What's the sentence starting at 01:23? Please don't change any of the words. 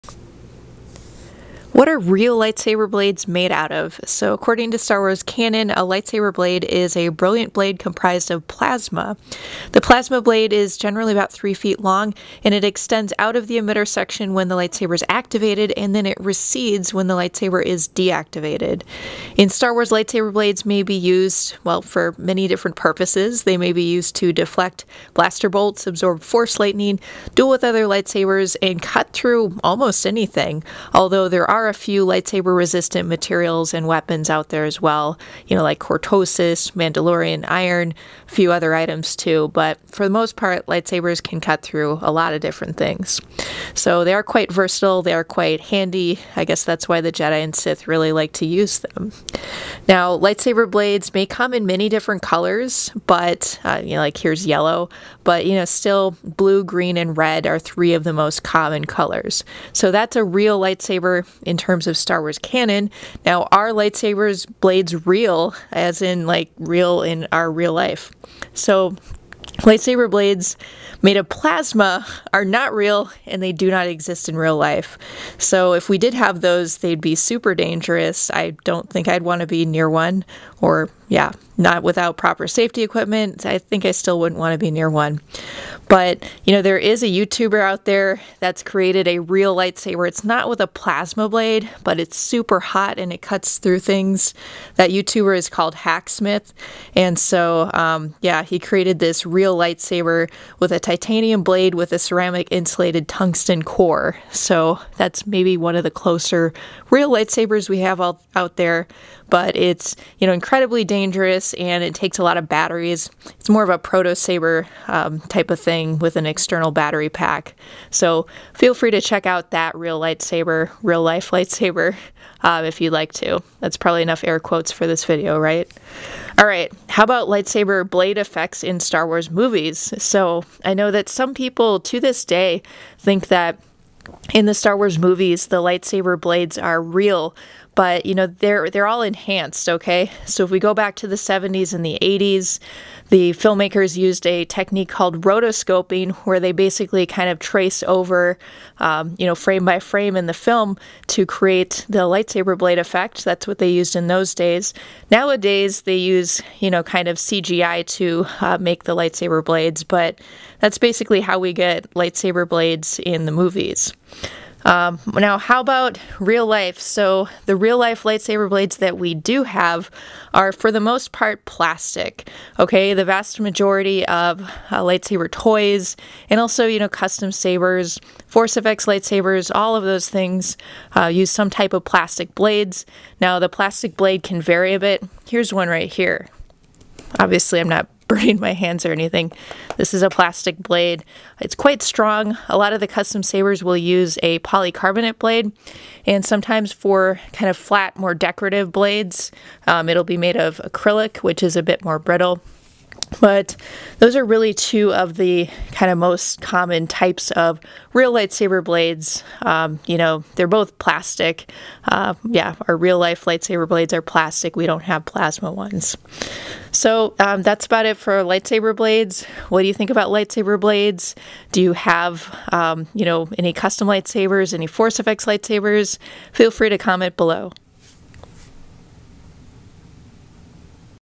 I think I still wouldn't want to be near one.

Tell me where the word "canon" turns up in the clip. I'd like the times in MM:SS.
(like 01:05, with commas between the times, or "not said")
00:05, 01:02.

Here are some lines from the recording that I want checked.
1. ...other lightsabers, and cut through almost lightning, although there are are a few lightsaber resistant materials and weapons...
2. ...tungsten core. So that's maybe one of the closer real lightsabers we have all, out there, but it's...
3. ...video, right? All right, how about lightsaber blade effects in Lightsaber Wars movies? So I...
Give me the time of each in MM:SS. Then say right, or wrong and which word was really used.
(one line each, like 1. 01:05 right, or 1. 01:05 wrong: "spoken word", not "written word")
1. 00:27 wrong: "anything", not "lightning"
2. 01:43 right
3. 02:05 wrong: "Star", not "Lightsaber".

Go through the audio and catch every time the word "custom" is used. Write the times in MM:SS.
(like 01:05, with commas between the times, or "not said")
02:56, 03:12, 03:43.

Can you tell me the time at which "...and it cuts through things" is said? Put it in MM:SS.
01:32.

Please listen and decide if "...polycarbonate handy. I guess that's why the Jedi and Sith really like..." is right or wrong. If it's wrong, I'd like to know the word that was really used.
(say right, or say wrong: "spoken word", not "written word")
wrong: "quite", not "polycarbonate".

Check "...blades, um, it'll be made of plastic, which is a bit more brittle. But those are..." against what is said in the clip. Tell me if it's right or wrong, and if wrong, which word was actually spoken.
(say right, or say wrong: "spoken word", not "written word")
wrong: "acrylic", not "plastic".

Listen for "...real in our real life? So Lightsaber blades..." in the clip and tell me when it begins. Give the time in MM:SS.
01:06.